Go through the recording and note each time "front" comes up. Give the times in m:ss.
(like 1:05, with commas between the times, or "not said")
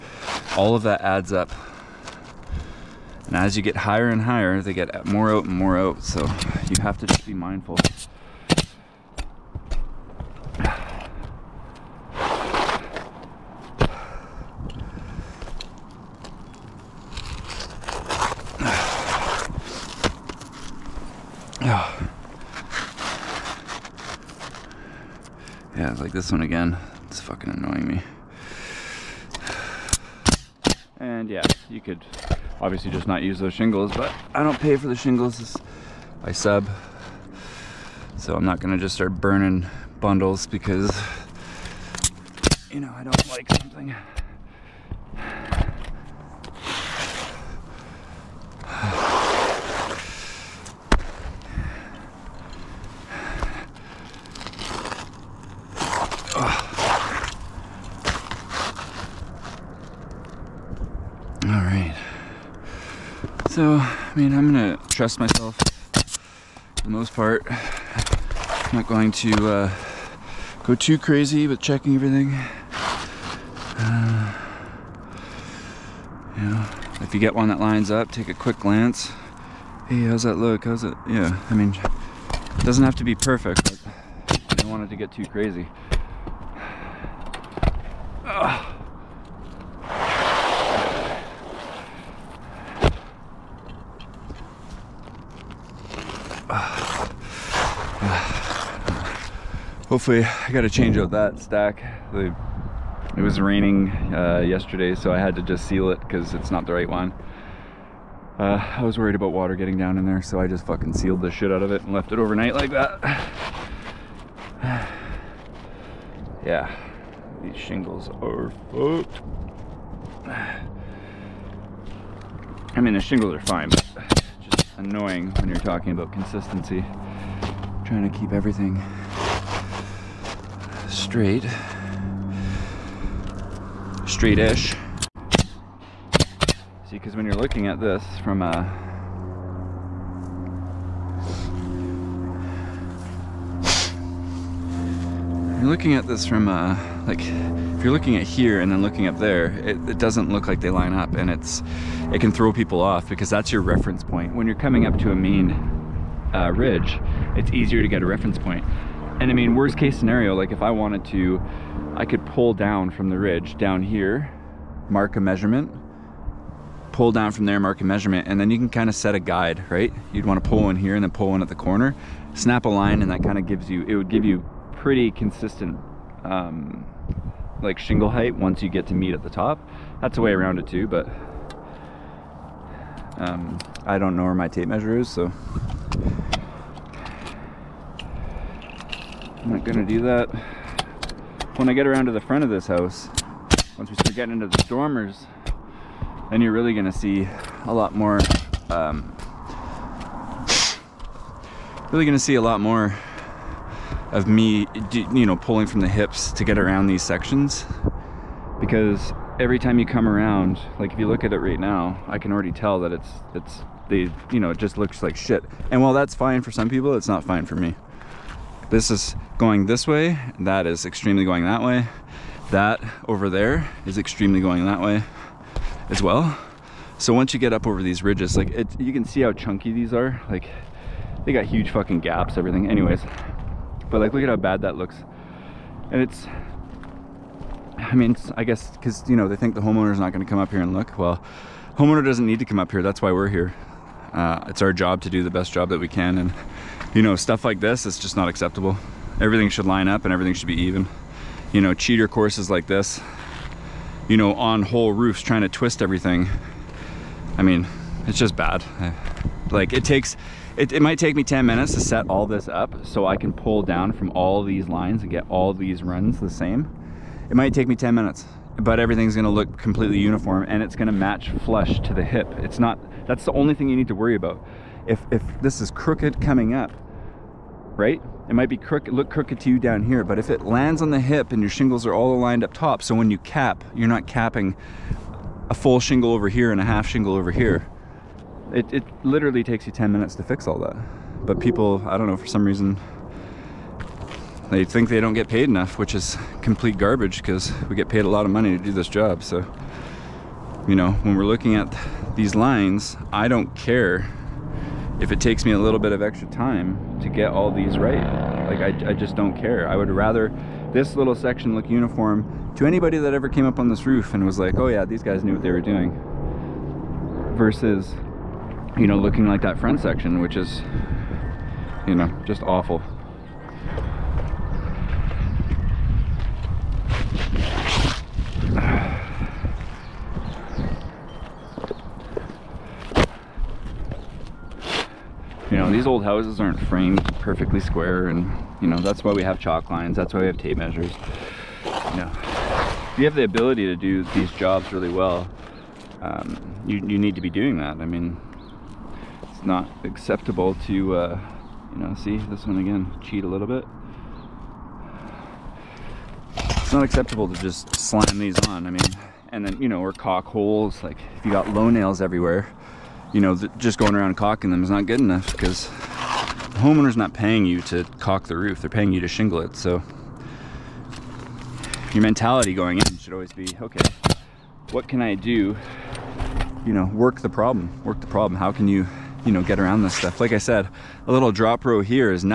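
3:12, 5:19.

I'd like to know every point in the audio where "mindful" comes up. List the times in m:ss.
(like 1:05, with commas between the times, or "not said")
0:07.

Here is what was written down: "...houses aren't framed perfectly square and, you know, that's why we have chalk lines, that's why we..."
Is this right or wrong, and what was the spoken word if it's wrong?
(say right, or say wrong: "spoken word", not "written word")
right.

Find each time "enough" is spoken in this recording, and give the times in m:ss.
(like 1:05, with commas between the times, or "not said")
4:55, 6:04.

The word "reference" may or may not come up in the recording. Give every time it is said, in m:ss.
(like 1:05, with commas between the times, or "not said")
2:33, 2:38.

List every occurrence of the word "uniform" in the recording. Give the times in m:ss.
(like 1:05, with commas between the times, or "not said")
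4:29, 5:11.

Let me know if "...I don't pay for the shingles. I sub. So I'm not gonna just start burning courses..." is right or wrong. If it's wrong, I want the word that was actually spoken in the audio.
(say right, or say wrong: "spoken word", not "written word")
wrong: "bundles", not "courses".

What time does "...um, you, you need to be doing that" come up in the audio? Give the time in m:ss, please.
5:46.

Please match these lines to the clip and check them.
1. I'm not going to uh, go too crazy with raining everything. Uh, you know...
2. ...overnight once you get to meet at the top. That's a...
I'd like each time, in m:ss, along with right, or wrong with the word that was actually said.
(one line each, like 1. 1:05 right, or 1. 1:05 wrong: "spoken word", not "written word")
1. 1:07 wrong: "checking", not "raining"
2. 2:58 wrong: "height", not "overnight".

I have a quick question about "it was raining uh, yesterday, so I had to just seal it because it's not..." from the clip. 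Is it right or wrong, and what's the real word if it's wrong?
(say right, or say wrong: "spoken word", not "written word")
right.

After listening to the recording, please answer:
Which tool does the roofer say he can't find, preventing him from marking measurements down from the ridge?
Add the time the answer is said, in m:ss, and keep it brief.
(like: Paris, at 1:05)
Tape measure, at 3:04.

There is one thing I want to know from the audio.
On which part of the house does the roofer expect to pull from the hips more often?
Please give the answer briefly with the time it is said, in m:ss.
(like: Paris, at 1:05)
The dormers, at 3:14.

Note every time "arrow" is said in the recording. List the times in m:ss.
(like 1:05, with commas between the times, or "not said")
not said.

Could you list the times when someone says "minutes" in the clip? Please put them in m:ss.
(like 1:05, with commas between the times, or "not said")
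4:21, 4:27, 4:49.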